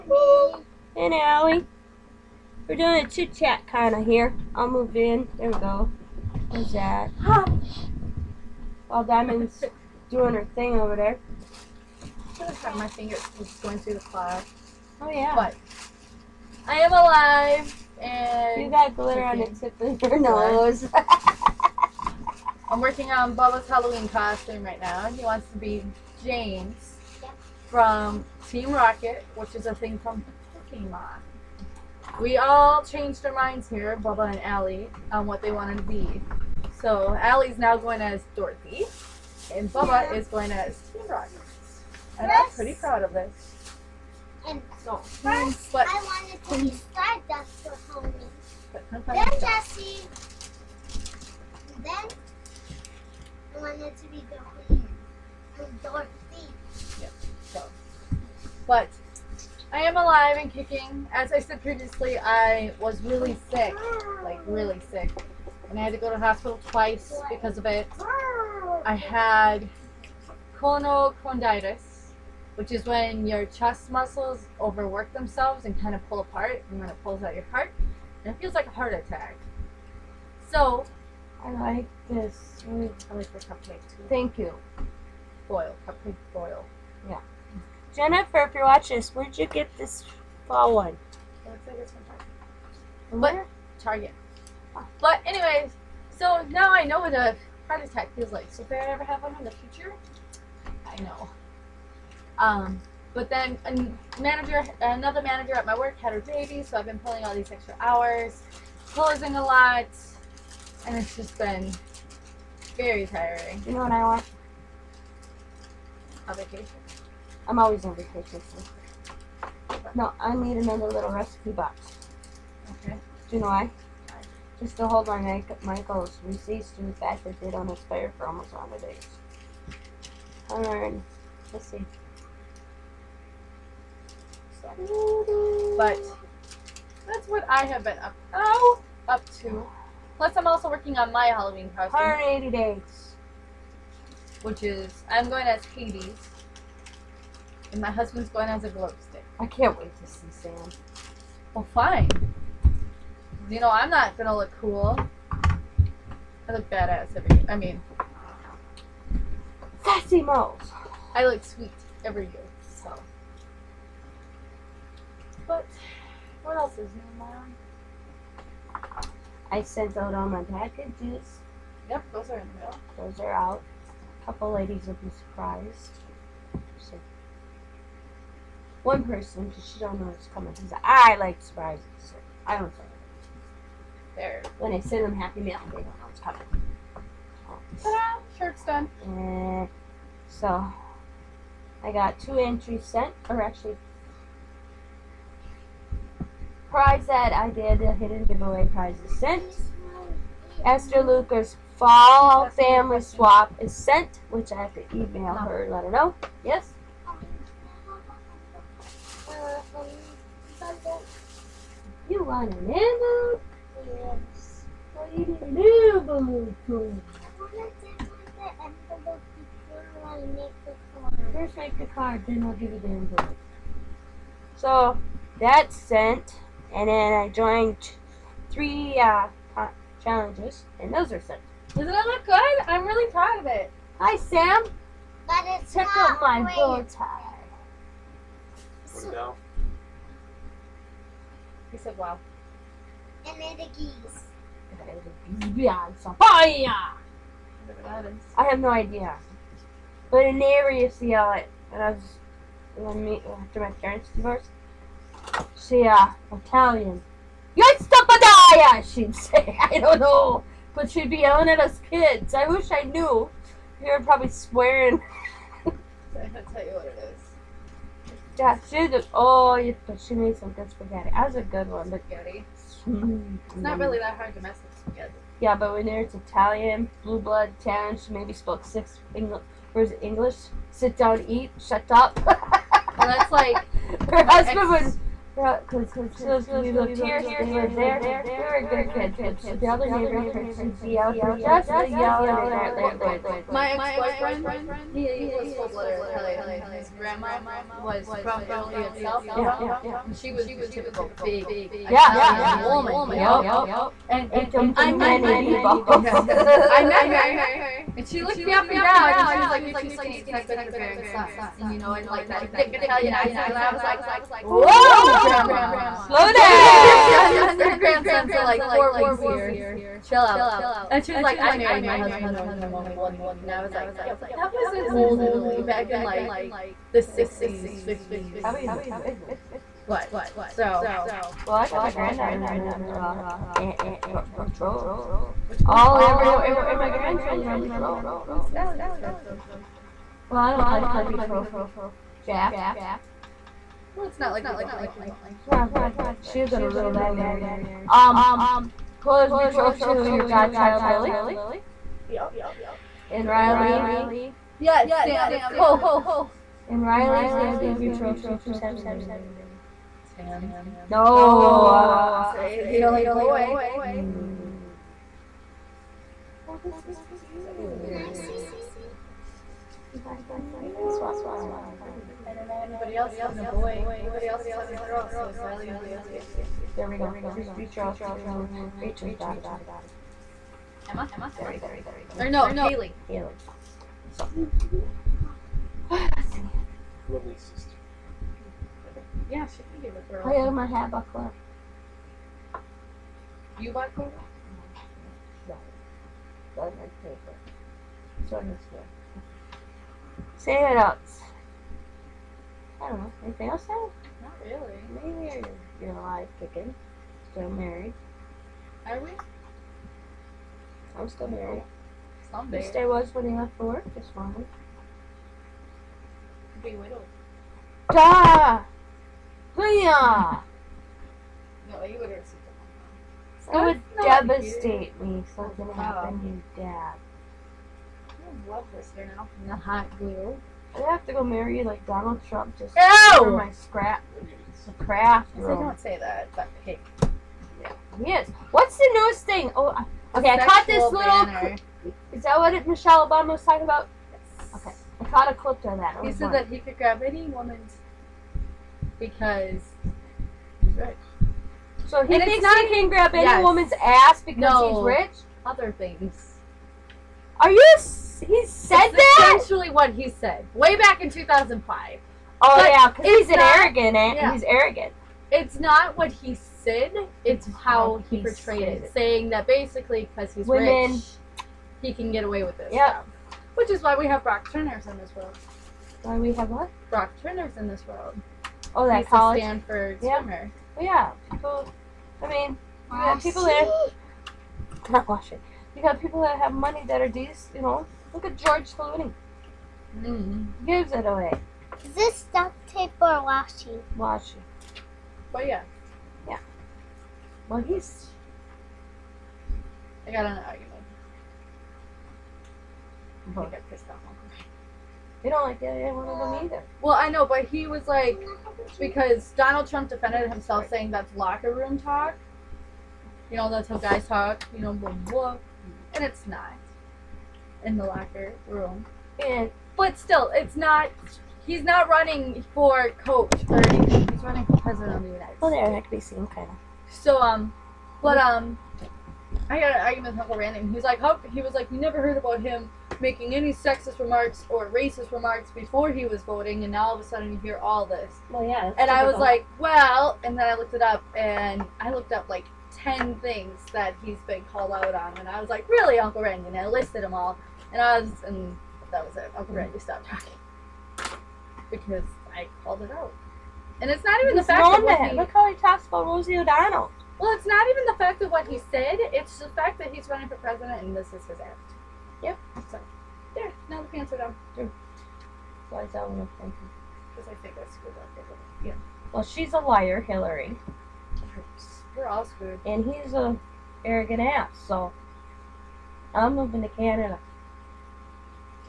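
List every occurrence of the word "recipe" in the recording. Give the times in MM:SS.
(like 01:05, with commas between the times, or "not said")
02:01.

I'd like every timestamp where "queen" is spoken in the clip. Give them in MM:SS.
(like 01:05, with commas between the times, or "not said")
00:54.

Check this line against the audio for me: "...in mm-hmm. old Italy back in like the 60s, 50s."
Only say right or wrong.
right.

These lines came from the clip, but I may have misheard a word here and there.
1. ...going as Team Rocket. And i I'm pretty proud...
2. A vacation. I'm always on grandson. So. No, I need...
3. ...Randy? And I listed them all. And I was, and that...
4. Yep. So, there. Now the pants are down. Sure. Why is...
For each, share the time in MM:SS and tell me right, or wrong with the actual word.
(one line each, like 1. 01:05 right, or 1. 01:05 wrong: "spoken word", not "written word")
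1. 00:40 right
2. 01:56 wrong: "vacation", not "grandson"
3. 09:06 right
4. 09:22 right.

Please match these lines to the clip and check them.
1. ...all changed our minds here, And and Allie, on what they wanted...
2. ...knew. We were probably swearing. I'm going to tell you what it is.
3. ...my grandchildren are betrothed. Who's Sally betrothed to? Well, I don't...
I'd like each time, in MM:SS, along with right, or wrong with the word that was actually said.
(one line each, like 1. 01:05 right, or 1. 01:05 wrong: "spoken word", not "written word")
1. 00:32 wrong: "Bubba", not "And"
2. 04:22 right
3. 05:36 right.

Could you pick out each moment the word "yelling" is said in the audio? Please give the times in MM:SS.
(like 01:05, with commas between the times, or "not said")
04:21, 04:51.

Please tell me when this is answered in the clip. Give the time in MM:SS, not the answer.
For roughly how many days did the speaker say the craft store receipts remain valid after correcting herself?
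02:22.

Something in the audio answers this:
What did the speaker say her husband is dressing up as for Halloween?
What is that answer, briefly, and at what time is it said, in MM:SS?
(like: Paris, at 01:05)
A glow stick, at 02:28.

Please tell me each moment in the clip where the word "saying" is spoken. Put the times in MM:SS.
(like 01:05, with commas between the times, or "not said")
07:48, 08:30.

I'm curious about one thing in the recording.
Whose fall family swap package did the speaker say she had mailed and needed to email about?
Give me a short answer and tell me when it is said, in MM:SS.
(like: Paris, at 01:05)
Esther Luker, at 03:20.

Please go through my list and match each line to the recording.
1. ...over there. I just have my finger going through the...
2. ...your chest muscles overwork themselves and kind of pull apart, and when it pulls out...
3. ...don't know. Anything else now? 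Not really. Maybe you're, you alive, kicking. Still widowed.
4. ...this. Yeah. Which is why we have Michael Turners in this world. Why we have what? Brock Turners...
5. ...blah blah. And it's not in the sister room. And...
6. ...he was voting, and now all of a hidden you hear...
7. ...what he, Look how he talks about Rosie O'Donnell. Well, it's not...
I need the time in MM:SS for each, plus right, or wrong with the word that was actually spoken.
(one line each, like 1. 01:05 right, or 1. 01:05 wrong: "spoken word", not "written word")
1. 00:10 right
2. 01:13 right
3. 06:42 wrong: "married", not "widowed"
4. 07:52 wrong: "Brock", not "Michael"
5. 08:34 wrong: "locker", not "sister"
6. 08:55 wrong: "sudden", not "hidden"
7. 09:15 right.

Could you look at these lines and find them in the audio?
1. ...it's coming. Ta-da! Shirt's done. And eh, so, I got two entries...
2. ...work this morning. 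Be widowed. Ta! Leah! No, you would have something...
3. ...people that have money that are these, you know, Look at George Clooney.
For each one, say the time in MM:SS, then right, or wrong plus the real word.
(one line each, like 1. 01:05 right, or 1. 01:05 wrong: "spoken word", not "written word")
1. 03:06 right
2. 06:53 right
3. 08:05 right.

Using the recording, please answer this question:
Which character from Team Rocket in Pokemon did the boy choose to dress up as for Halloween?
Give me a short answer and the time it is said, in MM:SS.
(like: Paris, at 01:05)
James, at 00:26.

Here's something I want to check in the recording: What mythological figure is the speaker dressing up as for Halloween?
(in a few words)
Hades.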